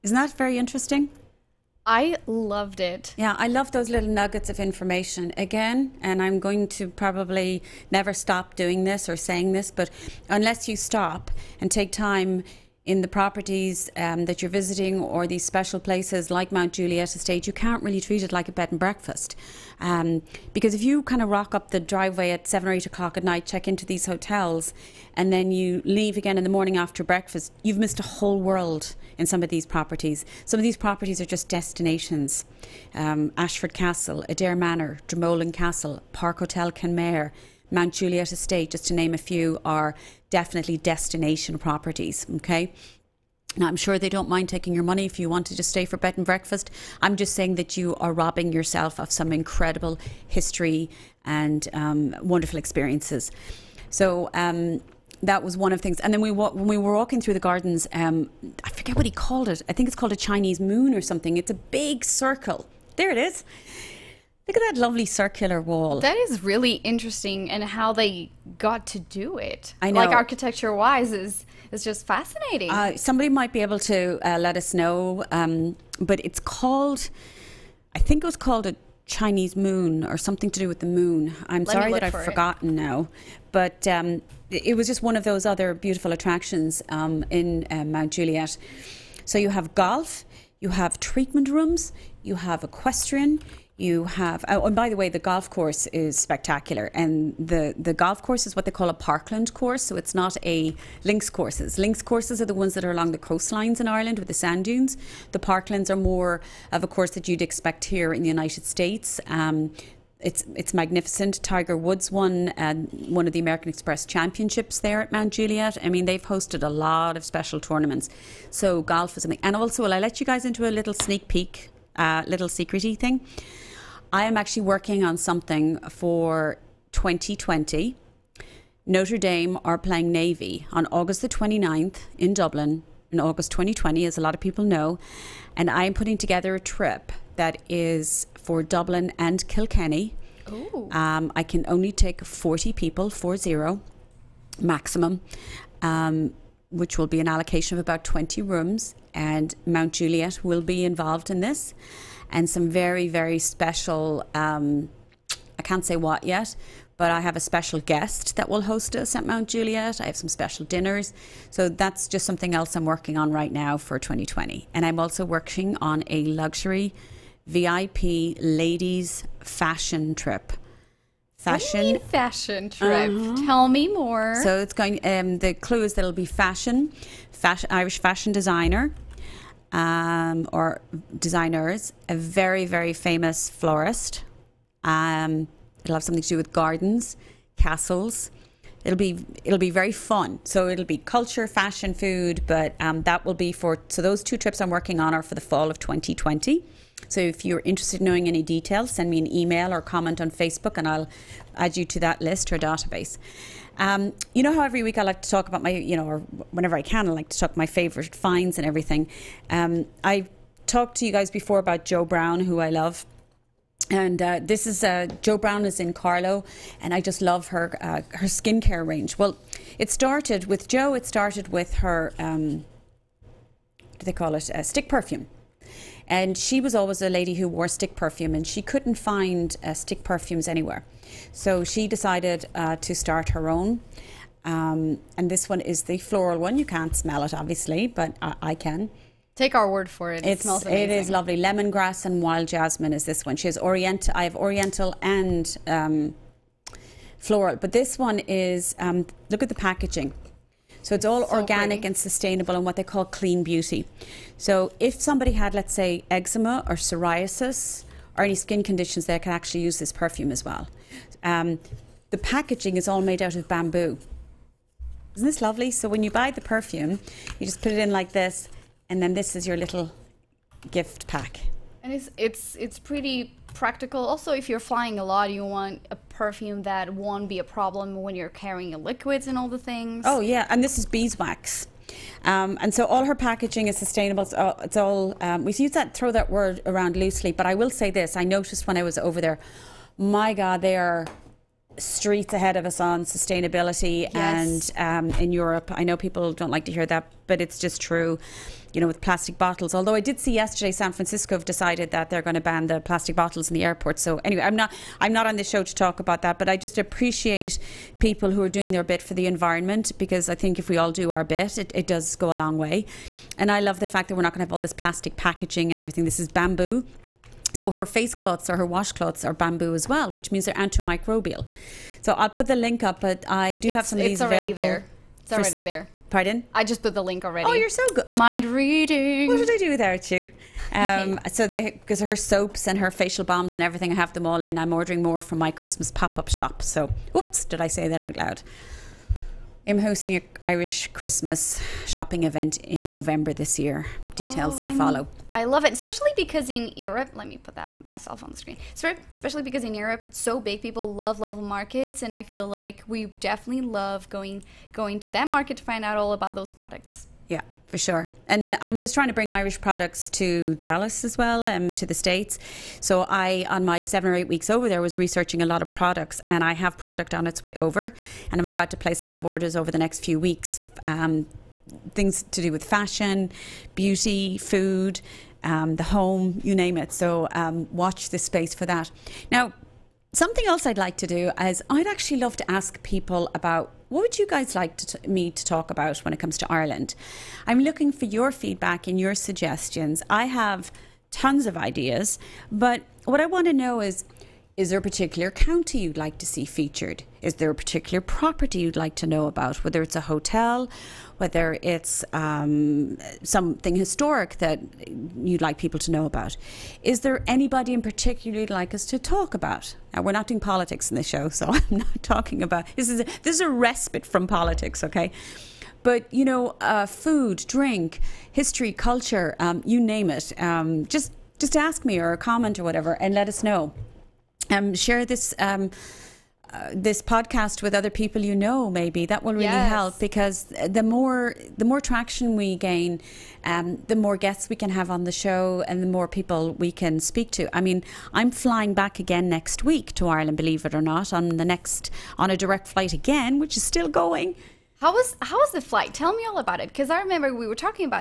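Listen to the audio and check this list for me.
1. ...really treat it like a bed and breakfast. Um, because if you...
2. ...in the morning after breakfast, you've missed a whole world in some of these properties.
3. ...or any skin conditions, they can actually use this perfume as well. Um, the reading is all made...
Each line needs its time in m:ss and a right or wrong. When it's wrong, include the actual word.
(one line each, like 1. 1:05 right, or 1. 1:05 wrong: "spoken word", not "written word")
1. 0:17 right
2. 0:26 right
3. 4:18 wrong: "packaging", not "reading".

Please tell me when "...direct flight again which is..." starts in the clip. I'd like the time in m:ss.
7:22.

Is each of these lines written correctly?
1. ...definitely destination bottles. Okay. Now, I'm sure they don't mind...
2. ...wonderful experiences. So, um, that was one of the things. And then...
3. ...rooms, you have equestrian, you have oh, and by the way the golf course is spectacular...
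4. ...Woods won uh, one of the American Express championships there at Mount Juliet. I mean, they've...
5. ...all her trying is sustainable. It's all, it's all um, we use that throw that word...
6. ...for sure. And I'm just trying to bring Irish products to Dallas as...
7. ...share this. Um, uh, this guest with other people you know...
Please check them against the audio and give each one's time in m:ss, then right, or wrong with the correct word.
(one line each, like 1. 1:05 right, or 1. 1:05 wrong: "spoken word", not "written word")
1. 0:40 wrong: "properties", not "bottles"
2. 0:52 right
3. 1:31 right
4. 1:51 right
5. 4:42 wrong: "packaging", not "trying"
6. 5:57 right
7. 7:04 wrong: "podcast", not "guest".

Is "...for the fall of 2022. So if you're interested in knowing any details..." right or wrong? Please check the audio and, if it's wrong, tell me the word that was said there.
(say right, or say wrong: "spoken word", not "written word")
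wrong: "2020", not "2022".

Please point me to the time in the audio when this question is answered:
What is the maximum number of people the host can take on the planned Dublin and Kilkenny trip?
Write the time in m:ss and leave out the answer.
2:22.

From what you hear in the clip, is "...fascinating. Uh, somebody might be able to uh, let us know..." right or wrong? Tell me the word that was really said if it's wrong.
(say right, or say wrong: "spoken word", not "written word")
right.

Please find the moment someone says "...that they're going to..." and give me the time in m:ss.
5:01.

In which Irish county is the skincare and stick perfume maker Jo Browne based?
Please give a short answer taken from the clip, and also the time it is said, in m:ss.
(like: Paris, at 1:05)
Carlow, at 3:35.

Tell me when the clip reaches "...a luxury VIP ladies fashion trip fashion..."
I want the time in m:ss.
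2:46.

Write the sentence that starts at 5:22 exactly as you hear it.
So I'll put the link up, but I do it's, have some of these available.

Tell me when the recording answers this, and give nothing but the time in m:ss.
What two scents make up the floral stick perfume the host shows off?
4:01.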